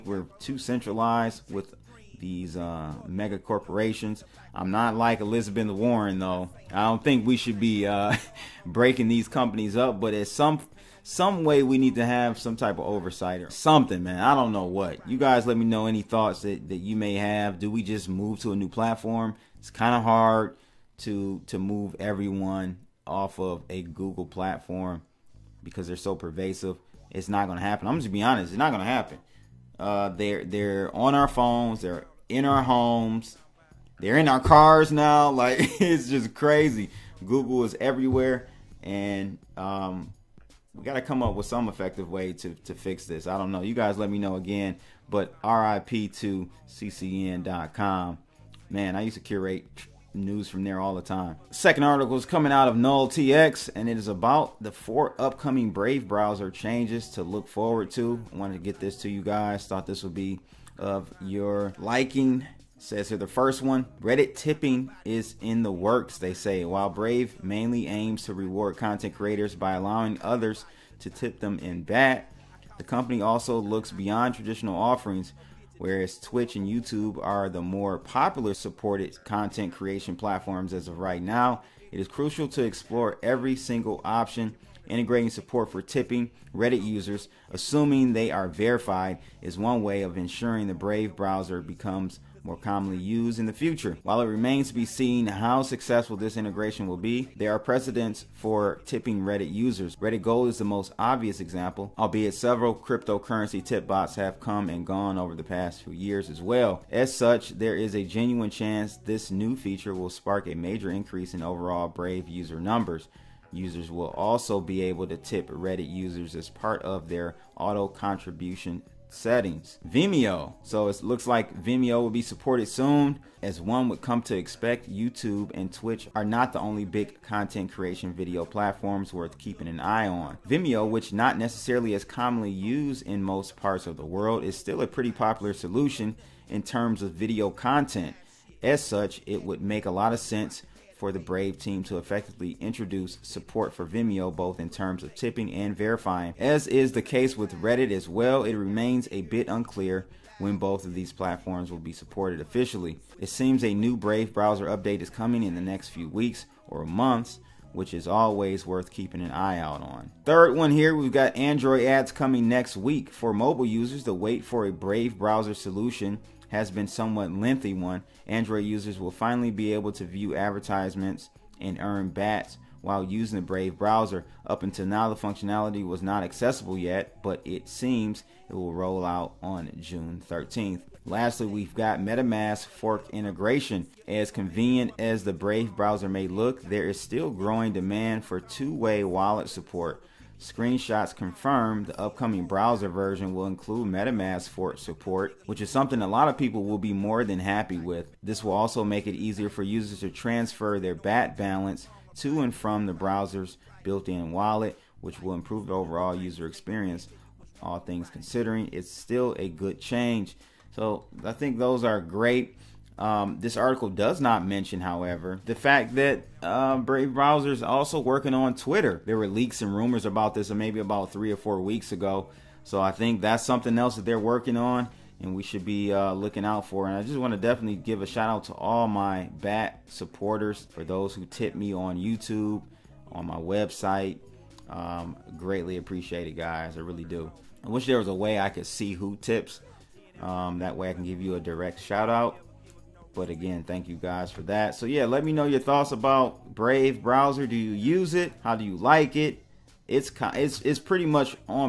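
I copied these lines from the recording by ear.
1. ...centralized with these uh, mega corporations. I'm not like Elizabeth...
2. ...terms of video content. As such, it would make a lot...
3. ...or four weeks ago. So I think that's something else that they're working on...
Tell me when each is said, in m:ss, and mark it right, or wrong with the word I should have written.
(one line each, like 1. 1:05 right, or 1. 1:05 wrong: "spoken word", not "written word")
1. 0:00 right
2. 2:16 right
3. 3:41 right.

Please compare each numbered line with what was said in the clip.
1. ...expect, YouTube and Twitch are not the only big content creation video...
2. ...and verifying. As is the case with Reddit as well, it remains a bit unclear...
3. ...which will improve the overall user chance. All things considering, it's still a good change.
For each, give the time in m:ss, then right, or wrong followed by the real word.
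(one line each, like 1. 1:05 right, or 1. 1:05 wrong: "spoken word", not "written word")
1. 2:04 right
2. 2:25 right
3. 3:25 wrong: "experience", not "chance".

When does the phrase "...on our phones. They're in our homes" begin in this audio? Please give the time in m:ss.
0:30.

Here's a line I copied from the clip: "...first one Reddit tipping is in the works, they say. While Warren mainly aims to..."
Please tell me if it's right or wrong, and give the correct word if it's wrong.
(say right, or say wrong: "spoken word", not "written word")
wrong: "Brave", not "Warren".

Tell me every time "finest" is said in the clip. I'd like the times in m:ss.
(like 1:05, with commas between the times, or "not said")
not said.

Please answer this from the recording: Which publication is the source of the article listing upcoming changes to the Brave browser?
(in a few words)
Null TX.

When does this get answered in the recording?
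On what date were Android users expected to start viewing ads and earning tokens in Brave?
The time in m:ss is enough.
2:59.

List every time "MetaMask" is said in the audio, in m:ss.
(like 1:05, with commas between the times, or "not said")
3:01, 3:13.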